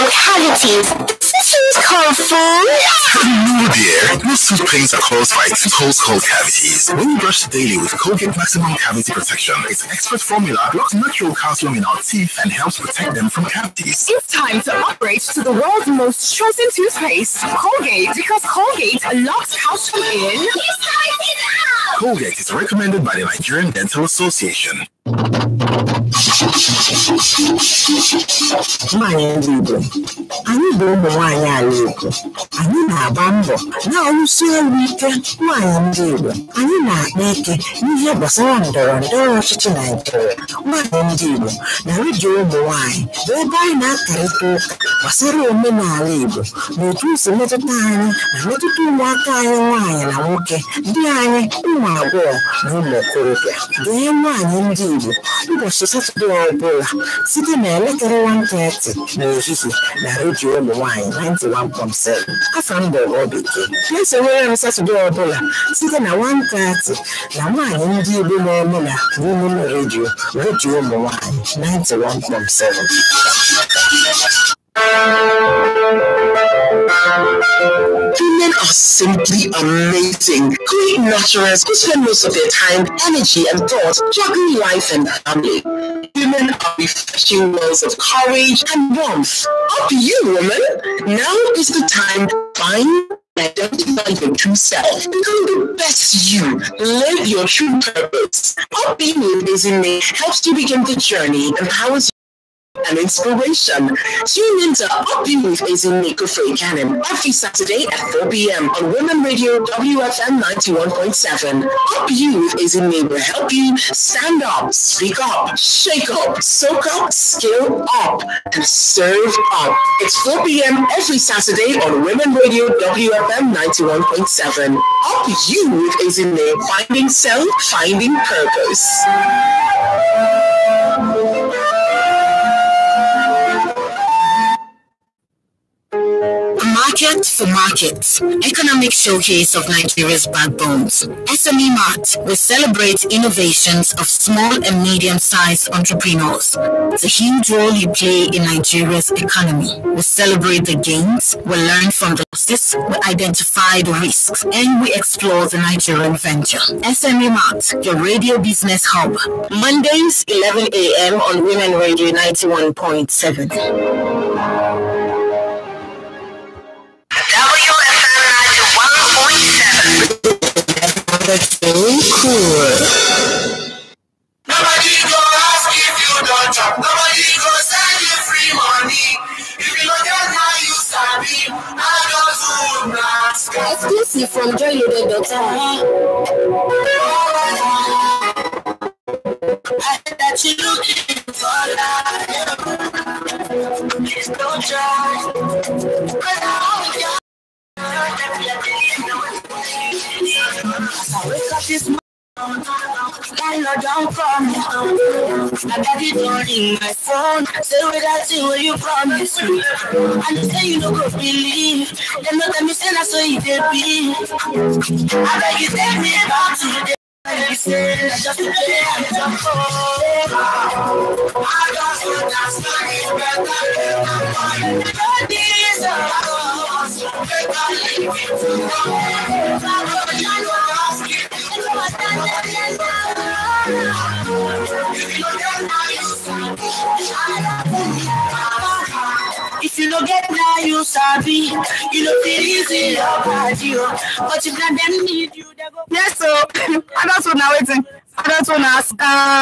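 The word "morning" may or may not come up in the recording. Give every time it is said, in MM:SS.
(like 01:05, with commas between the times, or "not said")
03:21.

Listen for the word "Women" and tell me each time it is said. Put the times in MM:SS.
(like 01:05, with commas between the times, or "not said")
01:26, 01:48, 02:02, 02:41.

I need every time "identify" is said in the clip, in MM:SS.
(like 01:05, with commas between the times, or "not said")
01:33, 02:33.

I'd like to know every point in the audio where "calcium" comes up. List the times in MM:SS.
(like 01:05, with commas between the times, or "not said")
00:11, 00:19.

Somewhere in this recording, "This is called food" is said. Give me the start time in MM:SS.
00:01.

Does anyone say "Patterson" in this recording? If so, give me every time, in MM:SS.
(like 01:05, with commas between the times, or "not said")
not said.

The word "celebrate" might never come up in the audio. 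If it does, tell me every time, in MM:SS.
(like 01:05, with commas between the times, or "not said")
02:22, 02:30.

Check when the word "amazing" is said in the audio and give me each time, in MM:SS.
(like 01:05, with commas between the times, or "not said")
01:19, 01:39.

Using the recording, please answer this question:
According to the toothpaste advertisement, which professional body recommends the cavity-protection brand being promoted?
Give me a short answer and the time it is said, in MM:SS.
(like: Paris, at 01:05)
Nigerian Dental Association, at 00:23.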